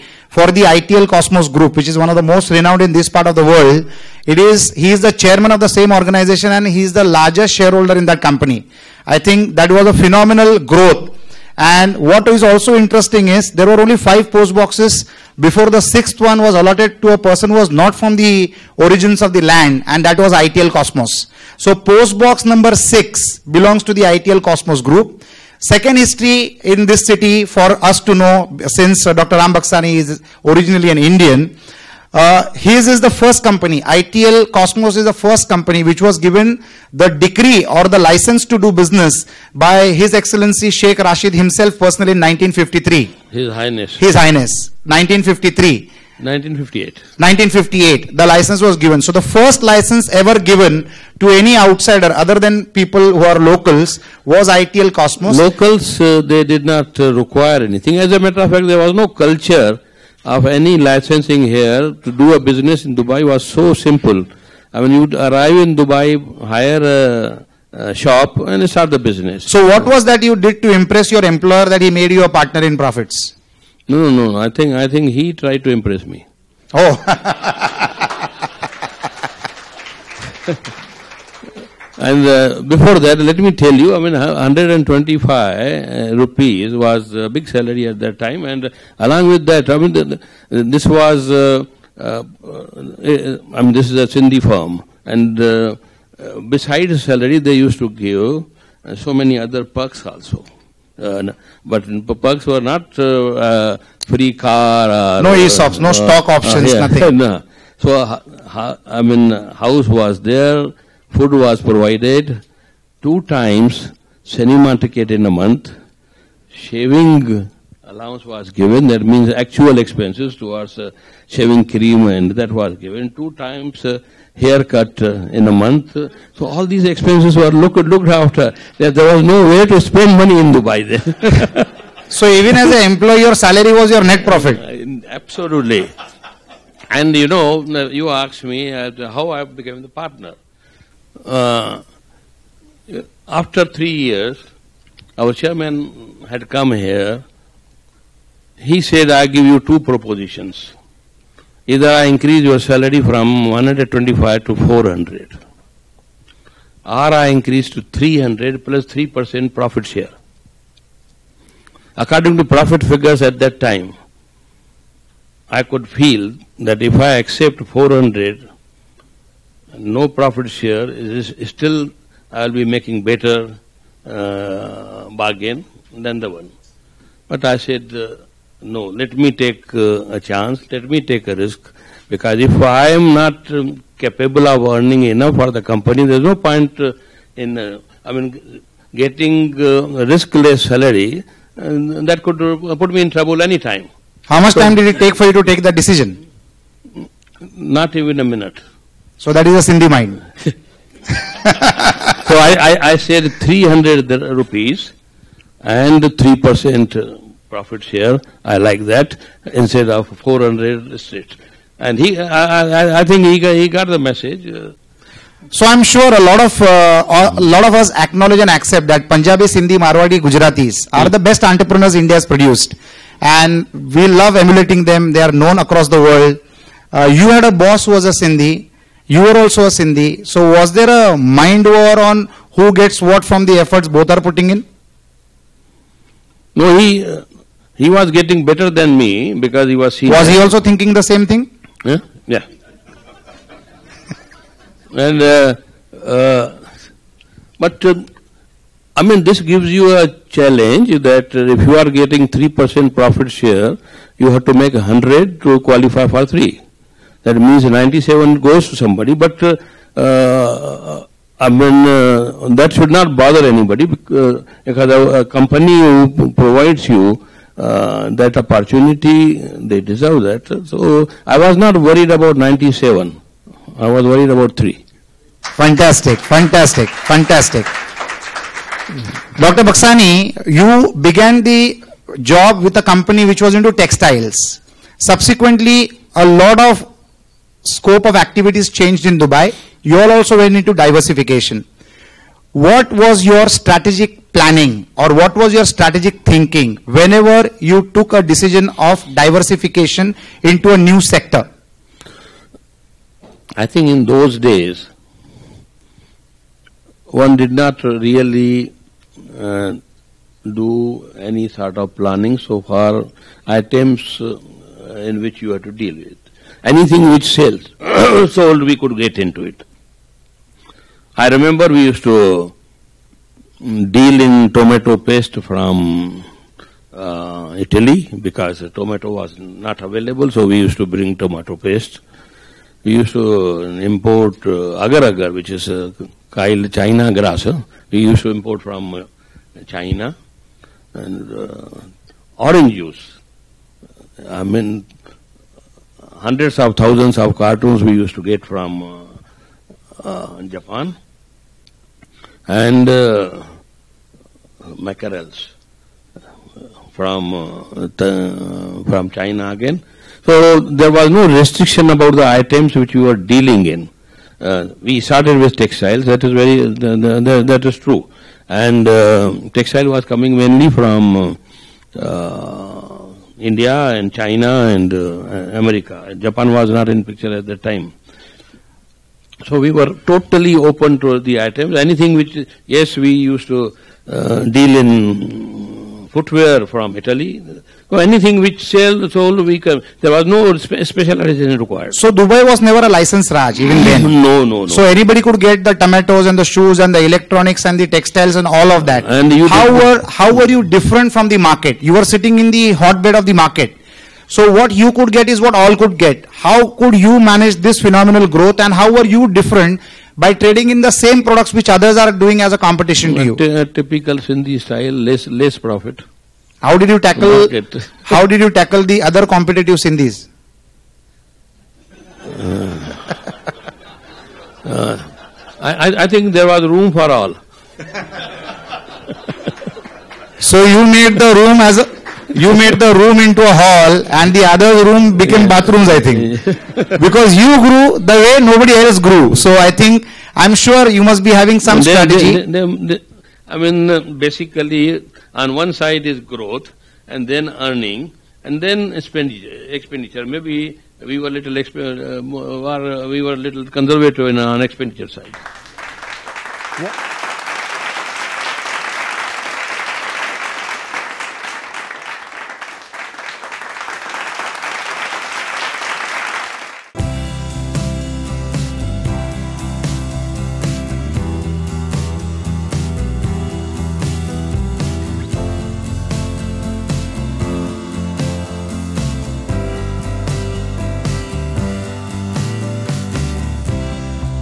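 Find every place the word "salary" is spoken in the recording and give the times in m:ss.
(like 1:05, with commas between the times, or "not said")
1:27, 1:37, 2:13, 2:32, 3:10.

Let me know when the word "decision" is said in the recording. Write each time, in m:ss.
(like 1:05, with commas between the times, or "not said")
3:15, 4:58.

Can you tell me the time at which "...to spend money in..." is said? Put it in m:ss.
2:09.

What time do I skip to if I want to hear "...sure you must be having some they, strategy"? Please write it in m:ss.
7:20.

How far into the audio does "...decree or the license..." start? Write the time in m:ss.
0:37.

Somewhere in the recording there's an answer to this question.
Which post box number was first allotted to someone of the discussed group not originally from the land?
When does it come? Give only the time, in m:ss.
0:21.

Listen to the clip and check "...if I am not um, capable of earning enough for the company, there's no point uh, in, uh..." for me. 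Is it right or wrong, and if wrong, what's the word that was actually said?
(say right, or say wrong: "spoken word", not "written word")
right.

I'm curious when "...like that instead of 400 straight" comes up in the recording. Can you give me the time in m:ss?
3:28.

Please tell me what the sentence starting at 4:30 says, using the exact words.
So I was not worried about 97.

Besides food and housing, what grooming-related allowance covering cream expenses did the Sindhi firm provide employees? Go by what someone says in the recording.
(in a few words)
Shaving allowance.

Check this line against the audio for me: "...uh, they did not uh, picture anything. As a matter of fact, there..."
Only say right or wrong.
wrong.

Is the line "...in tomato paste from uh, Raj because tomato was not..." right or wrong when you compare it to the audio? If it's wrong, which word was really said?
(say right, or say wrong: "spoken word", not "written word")
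wrong: "Italy", not "Raj".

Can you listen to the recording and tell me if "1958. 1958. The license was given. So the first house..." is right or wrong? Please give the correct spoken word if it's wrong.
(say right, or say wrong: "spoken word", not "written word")
wrong: "license", not "house".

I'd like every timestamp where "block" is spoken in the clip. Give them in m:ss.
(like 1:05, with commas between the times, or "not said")
not said.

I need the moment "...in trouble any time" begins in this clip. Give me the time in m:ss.
3:13.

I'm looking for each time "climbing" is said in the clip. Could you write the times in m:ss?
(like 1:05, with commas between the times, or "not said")
not said.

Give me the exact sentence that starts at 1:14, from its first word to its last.
I think, I think he tried to impress me.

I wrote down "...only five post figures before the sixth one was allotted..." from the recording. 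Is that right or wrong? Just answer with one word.
wrong.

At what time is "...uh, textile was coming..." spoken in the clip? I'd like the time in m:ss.
6:08.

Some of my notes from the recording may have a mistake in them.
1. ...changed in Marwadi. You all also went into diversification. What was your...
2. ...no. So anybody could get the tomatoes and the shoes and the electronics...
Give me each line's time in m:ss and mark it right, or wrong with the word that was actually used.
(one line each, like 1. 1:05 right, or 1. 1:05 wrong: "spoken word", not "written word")
1. 4:48 wrong: "Dubai", not "Marwadi"
2. 6:34 right.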